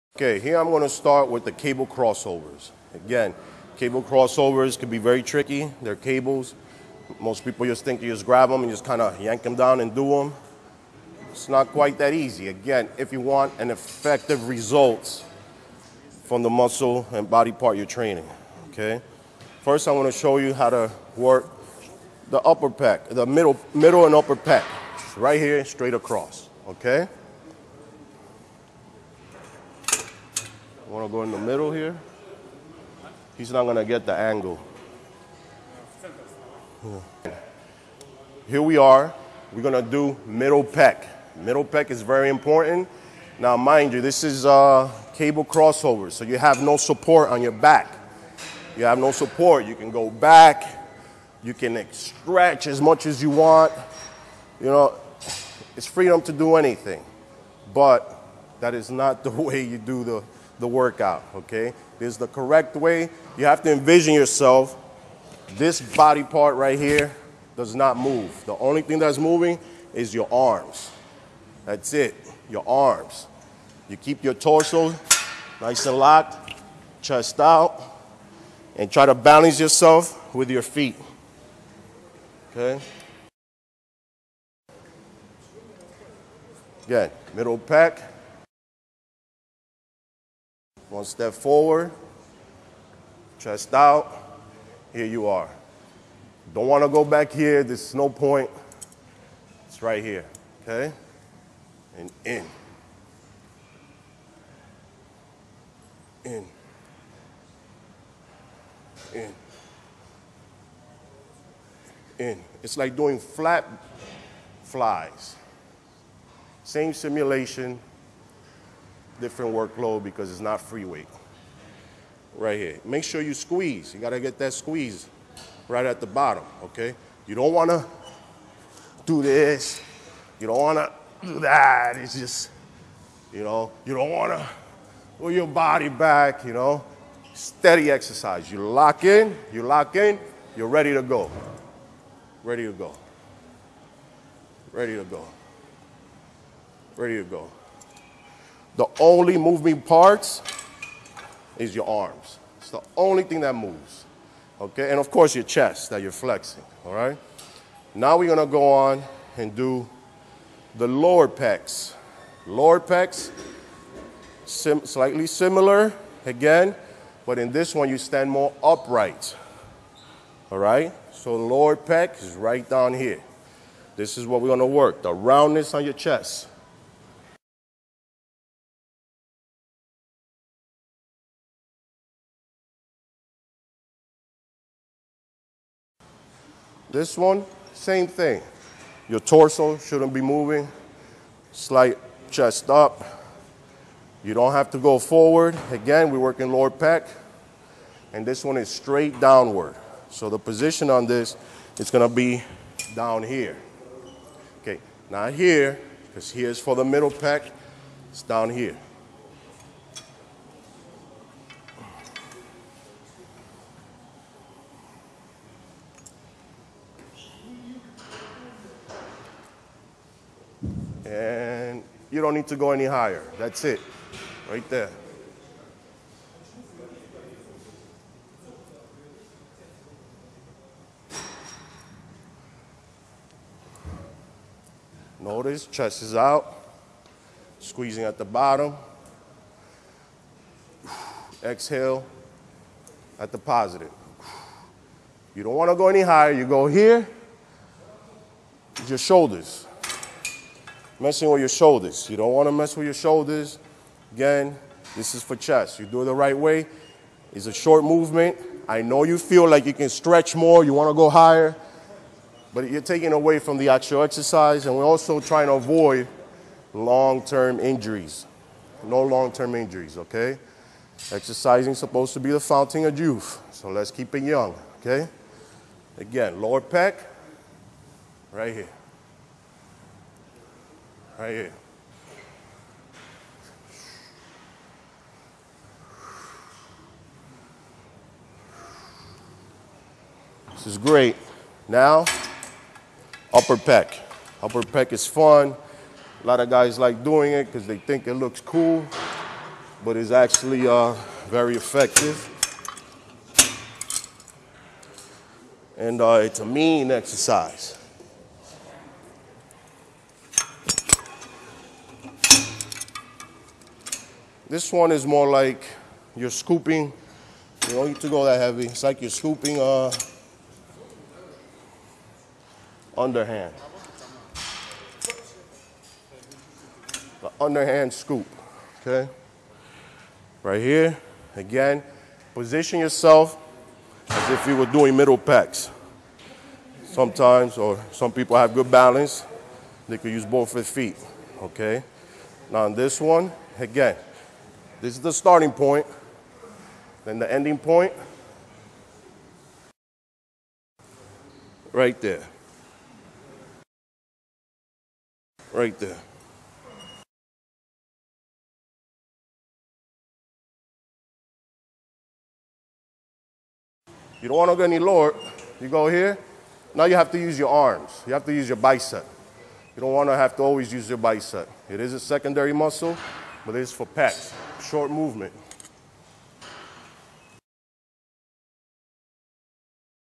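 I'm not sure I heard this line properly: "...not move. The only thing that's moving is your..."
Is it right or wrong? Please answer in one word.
right.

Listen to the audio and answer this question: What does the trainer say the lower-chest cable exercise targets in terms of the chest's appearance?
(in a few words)
the roundness.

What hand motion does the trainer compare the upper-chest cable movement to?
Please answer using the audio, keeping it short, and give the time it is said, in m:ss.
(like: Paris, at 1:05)
underhand scoop, at 5:27.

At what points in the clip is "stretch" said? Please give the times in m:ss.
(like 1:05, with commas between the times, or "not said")
0:51, 4:19.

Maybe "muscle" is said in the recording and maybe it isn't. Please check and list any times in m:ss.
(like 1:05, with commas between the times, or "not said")
0:16, 6:12.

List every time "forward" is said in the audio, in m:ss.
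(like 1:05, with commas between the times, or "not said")
1:31, 3:14.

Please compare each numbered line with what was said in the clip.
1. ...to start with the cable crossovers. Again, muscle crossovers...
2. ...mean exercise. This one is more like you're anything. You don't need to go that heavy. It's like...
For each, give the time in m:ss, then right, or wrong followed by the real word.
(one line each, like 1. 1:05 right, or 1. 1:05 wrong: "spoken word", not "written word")
1. 0:00 wrong: "cable", not "muscle"
2. 5:06 wrong: "scooping", not "anything".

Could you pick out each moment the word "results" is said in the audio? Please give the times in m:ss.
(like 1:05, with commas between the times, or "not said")
0:14.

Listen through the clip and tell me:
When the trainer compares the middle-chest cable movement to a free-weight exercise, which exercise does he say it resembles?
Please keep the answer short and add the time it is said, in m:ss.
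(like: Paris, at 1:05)
flat flies, at 1:53.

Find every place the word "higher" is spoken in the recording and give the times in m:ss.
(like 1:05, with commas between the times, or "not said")
3:42, 4:06, 4:21.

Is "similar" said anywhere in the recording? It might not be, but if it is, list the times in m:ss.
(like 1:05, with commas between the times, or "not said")
2:45.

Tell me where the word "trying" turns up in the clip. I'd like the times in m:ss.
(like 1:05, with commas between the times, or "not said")
4:25.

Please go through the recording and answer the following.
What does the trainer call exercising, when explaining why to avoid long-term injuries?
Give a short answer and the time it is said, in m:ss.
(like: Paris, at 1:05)
the fountain of youth, at 4:32.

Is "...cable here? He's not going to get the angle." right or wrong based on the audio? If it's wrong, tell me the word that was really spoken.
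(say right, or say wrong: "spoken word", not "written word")
wrong: "middle", not "cable".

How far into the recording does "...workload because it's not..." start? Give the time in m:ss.
1:59.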